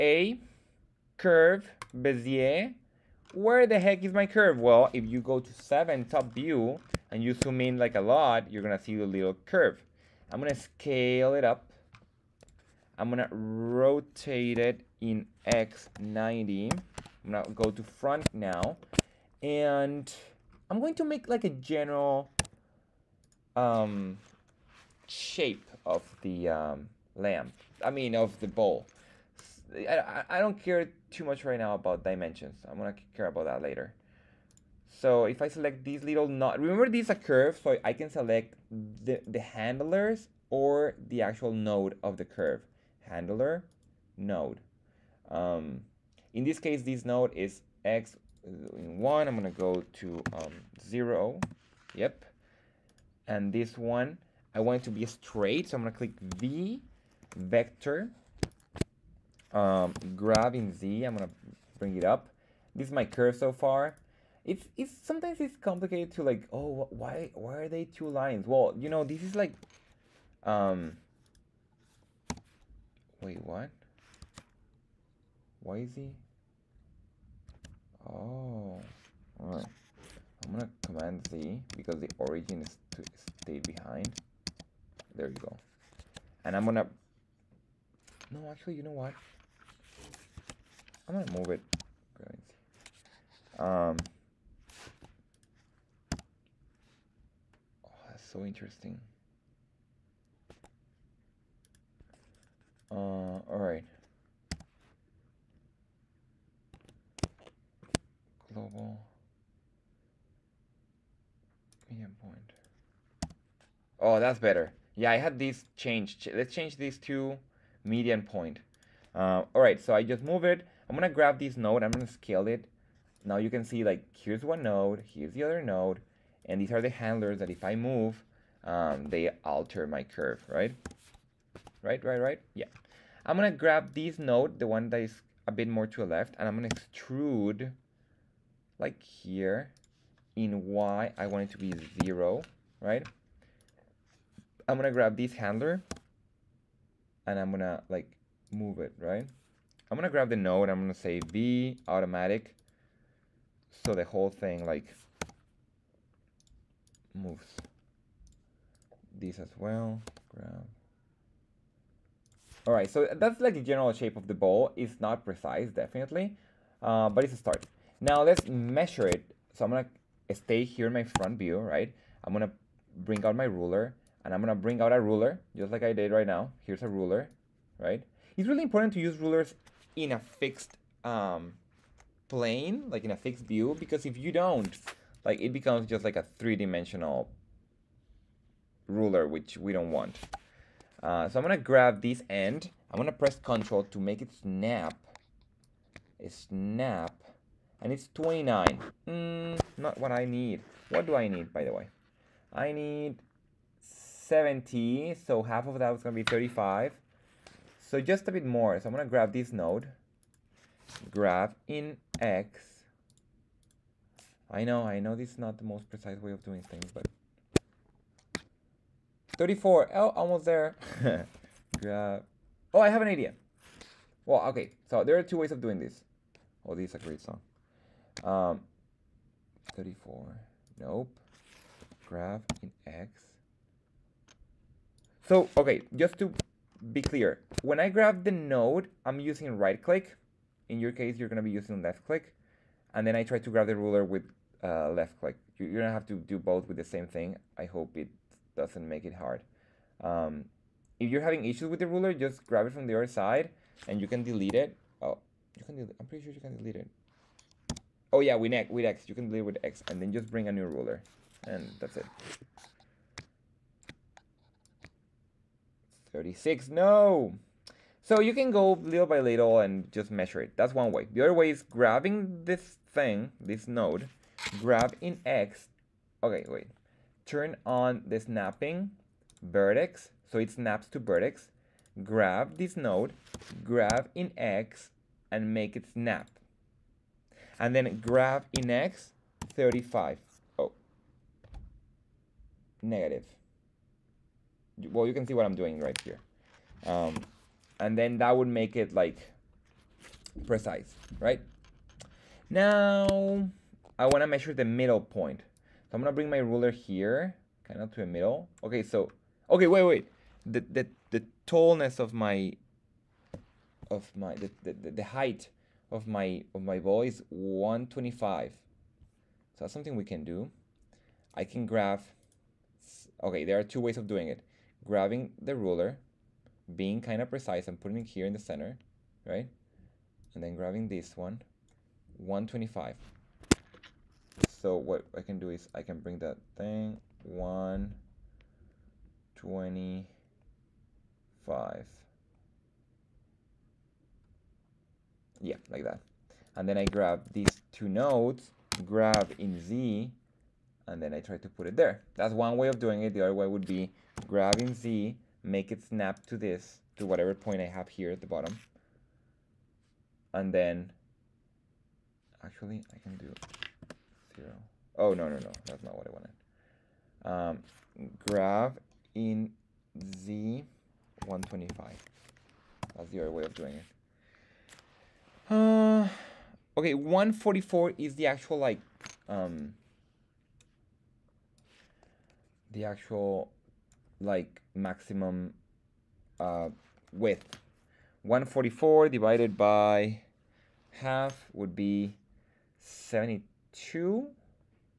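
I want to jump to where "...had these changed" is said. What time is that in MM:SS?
01:55.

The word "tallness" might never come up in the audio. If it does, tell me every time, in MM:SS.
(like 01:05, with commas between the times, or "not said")
05:11.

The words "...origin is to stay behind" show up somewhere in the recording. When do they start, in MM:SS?
01:22.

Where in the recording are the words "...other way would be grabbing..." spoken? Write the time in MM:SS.
05:53.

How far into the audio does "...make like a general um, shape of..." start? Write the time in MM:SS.
00:21.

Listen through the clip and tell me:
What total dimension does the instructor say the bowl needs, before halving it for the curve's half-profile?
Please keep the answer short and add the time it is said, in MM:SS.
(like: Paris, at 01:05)
70, at 03:22.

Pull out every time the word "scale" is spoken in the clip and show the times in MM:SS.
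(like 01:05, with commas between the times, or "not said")
00:10, 02:02.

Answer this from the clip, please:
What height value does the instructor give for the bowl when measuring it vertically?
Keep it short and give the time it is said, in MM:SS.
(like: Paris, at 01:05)
125, at 05:14.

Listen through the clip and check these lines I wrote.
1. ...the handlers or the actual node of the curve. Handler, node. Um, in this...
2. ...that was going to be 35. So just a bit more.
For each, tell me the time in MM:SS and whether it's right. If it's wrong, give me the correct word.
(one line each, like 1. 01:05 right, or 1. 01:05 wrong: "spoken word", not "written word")
1. 00:39 right
2. 03:25 right.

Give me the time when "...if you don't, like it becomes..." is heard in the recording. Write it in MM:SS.
03:04.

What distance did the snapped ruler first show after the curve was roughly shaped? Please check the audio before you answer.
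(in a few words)
29.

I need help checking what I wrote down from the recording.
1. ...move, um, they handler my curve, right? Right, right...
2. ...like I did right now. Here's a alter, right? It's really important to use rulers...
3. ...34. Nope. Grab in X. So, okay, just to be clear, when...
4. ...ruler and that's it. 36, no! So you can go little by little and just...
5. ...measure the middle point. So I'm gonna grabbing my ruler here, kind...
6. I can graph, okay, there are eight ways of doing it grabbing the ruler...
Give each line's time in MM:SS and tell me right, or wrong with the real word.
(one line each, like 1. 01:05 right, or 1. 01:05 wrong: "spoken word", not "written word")
1. 02:07 wrong: "alter", not "handler"
2. 02:55 wrong: "ruler", not "alter"
3. 03:49 right
4. 04:20 right
5. 05:04 wrong: "bring", not "grabbing"
6. 05:21 wrong: "two", not "eight".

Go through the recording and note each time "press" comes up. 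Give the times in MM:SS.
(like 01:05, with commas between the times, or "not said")
03:13.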